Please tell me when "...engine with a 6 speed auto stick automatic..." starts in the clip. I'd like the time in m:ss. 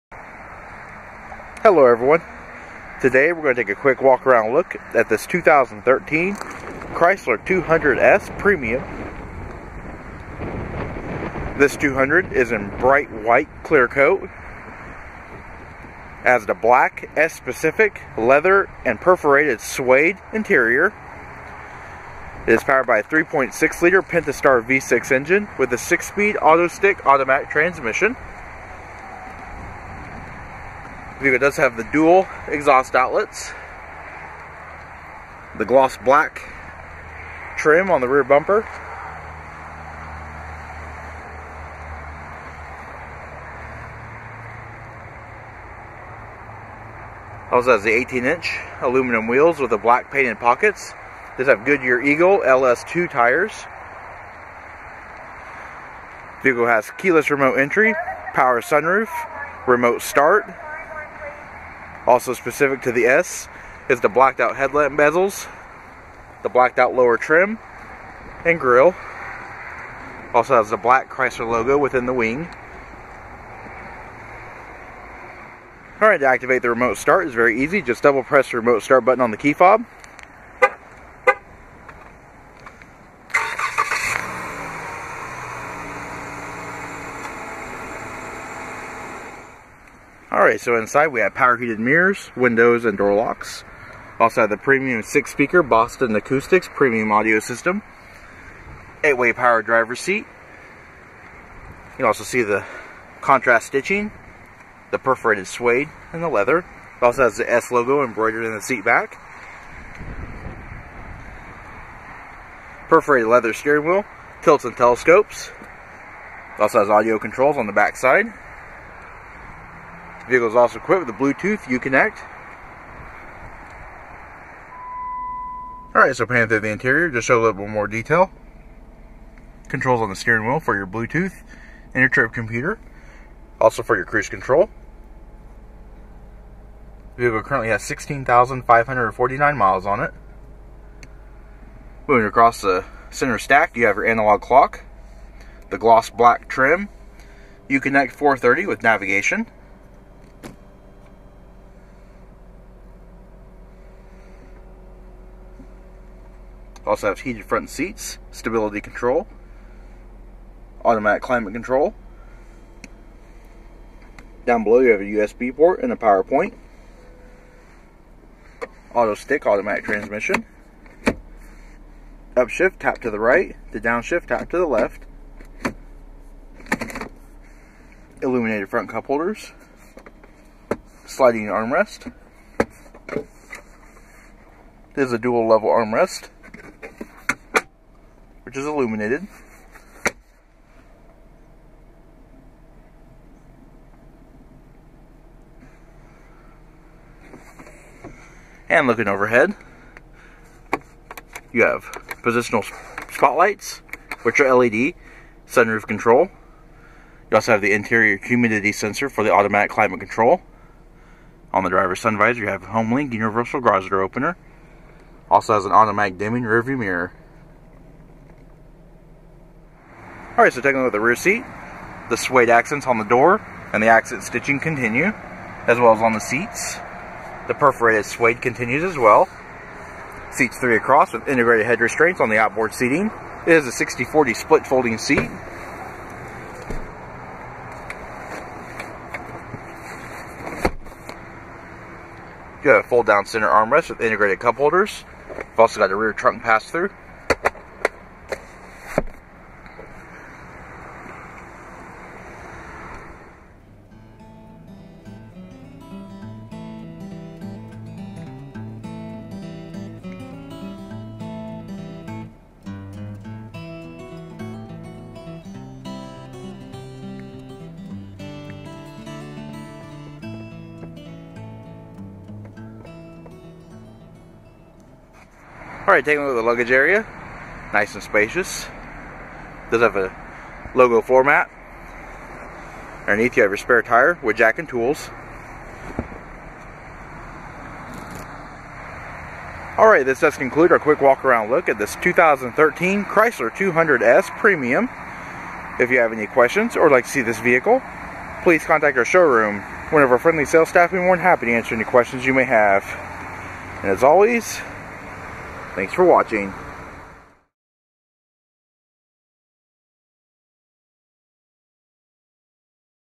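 0:25.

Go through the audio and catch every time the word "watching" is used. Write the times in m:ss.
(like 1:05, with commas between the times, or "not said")
5:06.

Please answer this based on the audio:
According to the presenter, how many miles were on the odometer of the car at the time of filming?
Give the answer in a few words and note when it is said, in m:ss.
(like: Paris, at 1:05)
16,549, at 2:17.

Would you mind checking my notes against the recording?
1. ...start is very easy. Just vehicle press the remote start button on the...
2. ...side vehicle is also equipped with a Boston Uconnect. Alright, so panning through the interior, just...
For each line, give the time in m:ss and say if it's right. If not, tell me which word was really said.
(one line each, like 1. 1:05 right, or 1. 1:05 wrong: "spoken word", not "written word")
1. 1:16 wrong: "double", not "vehicle"
2. 1:57 wrong: "Bluetooth", not "Boston".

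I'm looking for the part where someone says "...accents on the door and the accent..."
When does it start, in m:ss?
3:42.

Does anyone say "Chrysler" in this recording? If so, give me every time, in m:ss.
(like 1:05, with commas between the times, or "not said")
0:06, 1:11, 4:53.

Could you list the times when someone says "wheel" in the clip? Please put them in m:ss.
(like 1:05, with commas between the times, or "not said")
0:49, 1:53, 2:10.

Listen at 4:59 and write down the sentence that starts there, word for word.
One of our friendly sales staff will be more than happy to answer any questions you may have.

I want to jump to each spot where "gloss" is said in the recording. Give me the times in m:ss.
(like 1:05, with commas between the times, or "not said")
0:35, 2:25.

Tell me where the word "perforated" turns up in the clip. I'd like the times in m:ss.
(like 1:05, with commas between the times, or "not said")
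0:18, 1:44, 1:52, 3:47.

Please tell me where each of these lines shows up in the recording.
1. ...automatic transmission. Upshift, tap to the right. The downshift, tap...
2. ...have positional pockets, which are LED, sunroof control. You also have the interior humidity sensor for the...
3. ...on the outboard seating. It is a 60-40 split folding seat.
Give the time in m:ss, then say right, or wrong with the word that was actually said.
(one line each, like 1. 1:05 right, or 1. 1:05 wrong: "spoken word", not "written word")
1. 2:49 right
2. 3:21 wrong: "spotlights", not "pockets"
3. 3:52 right.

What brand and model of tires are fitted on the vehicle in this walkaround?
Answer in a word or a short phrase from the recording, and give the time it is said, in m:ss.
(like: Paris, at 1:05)
Goodyear Eagle LS2, at 0:51.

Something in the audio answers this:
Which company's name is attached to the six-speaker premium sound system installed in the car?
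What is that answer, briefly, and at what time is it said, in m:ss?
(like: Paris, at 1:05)
Boston Acoustics, at 1:35.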